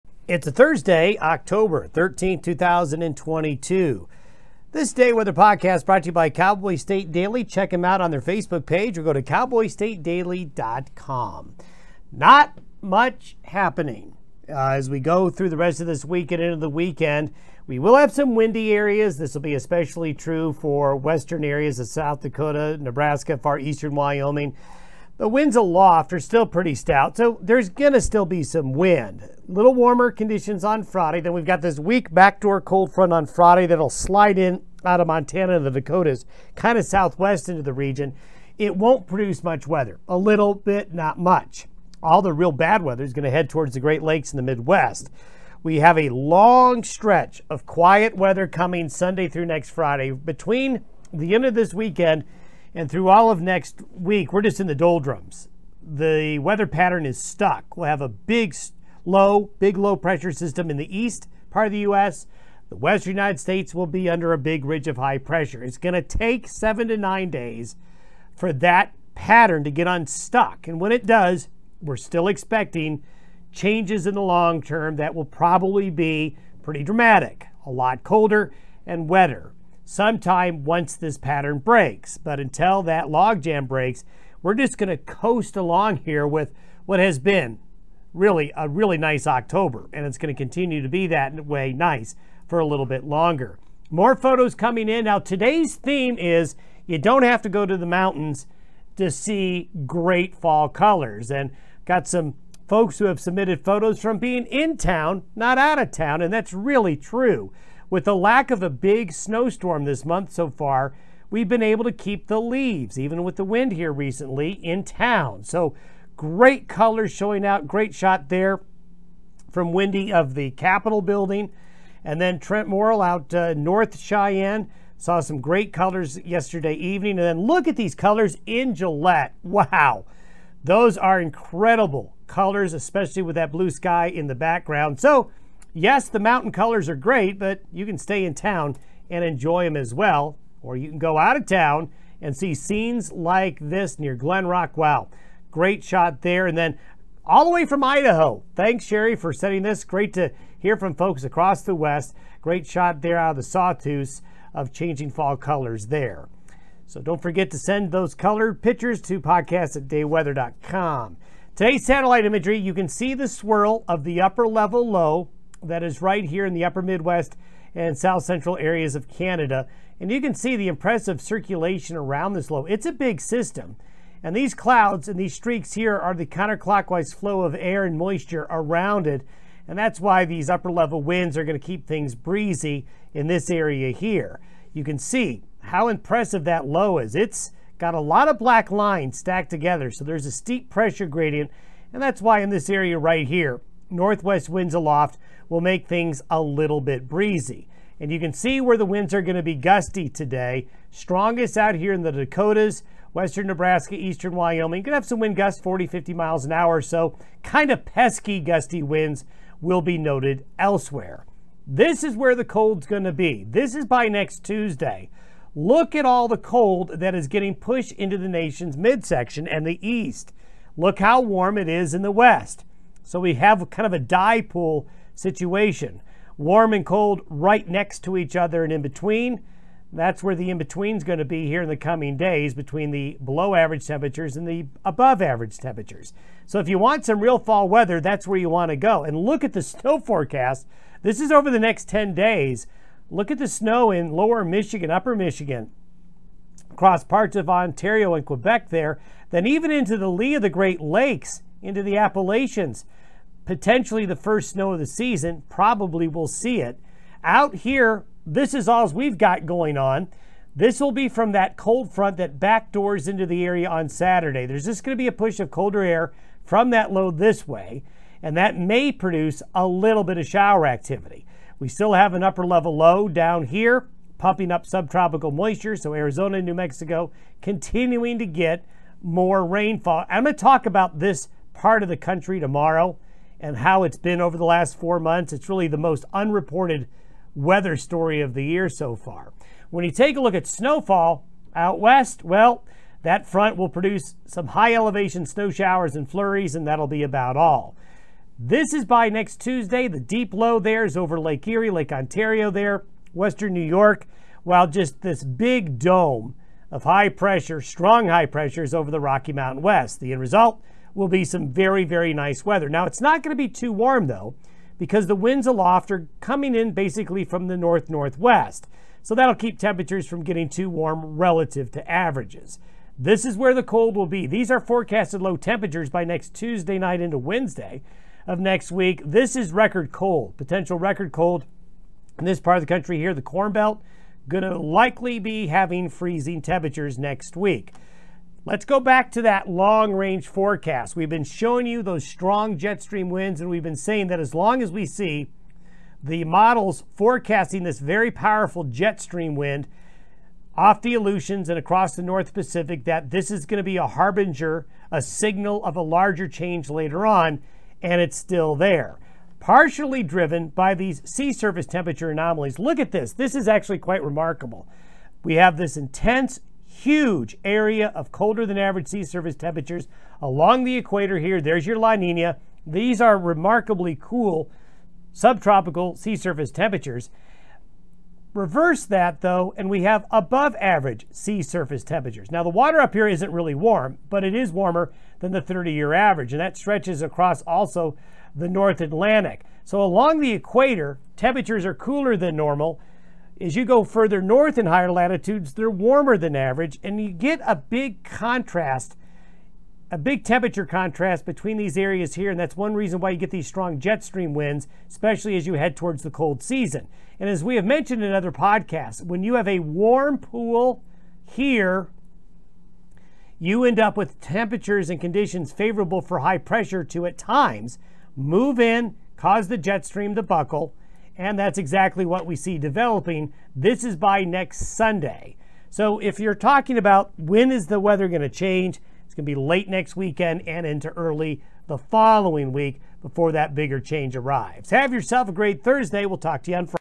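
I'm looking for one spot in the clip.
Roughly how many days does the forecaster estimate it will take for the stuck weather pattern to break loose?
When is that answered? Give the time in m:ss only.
1:06.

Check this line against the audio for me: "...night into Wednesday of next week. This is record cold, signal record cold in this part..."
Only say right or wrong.
wrong.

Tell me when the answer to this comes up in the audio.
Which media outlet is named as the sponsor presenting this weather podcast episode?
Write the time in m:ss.
0:06.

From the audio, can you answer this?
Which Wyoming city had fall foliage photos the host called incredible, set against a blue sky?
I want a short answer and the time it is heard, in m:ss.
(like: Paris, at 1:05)
Gillette, at 2:08.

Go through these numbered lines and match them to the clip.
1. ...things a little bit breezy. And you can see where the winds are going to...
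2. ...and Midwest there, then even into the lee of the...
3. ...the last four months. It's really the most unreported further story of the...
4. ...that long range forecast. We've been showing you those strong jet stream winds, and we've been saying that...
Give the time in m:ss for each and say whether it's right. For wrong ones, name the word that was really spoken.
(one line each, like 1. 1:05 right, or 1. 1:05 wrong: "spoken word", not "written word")
1. 3:15 right
2. 4:08 wrong: "Quebec", not "Midwest"
3. 4:44 wrong: "weather", not "further"
4. 5:39 right.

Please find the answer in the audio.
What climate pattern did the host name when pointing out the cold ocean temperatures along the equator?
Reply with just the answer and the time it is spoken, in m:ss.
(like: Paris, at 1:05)
La Nina, at 6:11.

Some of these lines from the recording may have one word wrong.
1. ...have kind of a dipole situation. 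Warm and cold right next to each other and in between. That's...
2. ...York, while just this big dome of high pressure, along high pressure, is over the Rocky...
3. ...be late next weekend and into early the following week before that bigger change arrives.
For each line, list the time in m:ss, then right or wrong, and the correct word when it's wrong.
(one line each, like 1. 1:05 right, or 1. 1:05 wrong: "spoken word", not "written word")
1. 3:43 right
2. 5:03 wrong: "strong", not "along"
3. 7:09 right.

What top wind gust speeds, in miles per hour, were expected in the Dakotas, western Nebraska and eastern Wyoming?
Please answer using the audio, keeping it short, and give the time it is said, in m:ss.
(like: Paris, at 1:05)
40, 50, at 3:25.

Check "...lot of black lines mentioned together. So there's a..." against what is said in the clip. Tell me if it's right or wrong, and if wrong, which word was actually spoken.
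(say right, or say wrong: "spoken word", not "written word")
wrong: "stacked", not "mentioned".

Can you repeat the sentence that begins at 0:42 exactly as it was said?
All the real bad weather is going to head towards the Great Lakes in the Midwest.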